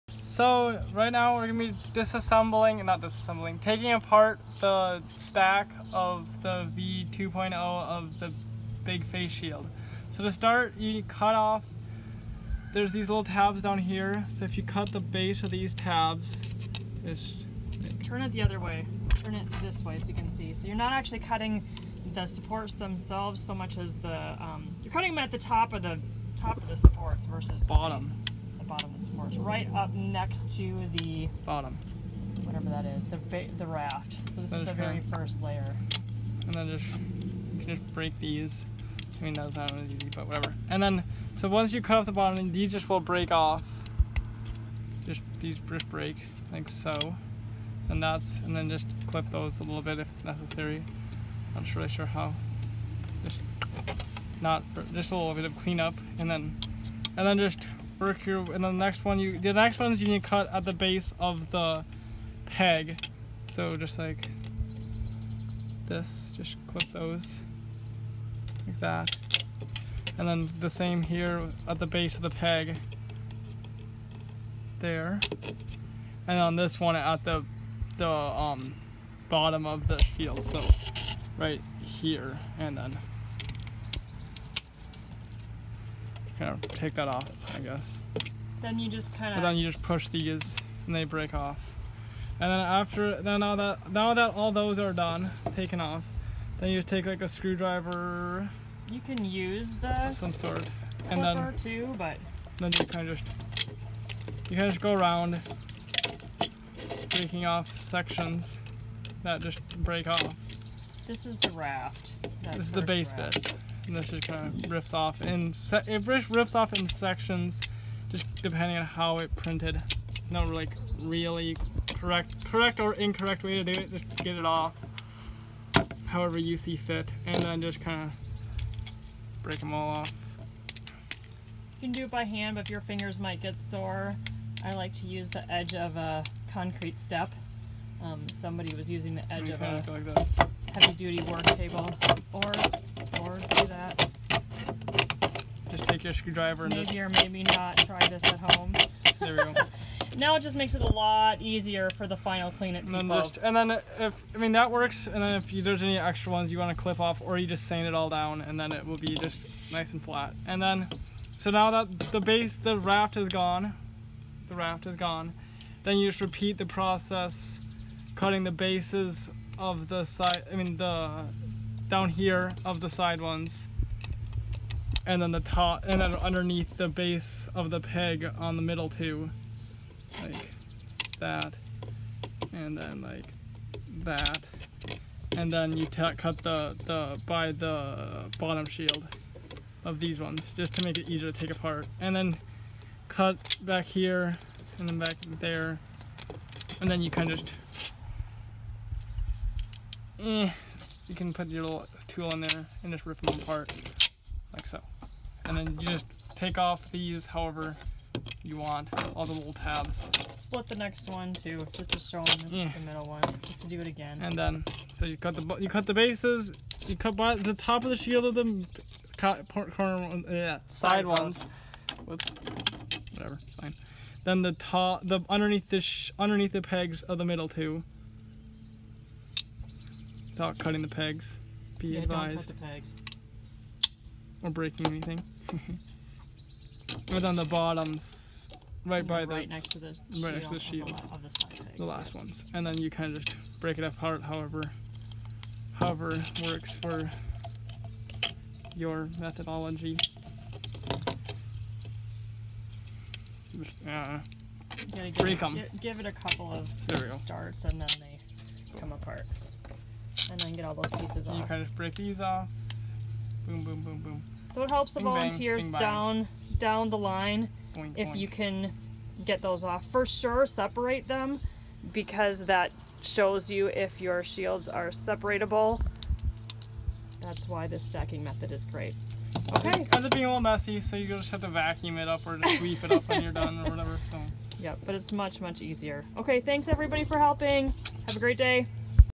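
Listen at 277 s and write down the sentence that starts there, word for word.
That's why this stacking method is great.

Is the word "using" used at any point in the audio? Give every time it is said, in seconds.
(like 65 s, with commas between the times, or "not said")
138 s.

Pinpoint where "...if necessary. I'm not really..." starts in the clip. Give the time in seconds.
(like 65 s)
49 s.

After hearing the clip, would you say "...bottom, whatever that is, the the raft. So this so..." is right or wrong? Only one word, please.
right.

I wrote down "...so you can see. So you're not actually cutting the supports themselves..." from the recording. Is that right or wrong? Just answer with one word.
right.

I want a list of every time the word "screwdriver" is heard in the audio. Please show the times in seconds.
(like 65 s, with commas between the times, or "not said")
97 s, 146 s.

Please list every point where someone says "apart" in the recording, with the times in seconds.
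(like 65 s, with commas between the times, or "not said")
3 s, 191 s, 203 s, 243 s, 258 s.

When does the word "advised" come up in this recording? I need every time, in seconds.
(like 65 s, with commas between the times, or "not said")
232 s.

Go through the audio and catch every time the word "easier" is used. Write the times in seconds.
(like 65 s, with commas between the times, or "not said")
151 s, 191 s, 285 s.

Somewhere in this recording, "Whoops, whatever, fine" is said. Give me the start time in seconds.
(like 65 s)
222 s.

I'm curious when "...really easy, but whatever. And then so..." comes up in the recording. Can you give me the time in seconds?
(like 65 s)
39 s.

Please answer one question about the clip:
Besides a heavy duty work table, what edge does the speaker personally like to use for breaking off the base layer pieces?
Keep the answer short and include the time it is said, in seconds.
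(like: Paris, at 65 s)
concrete step, at 136 s.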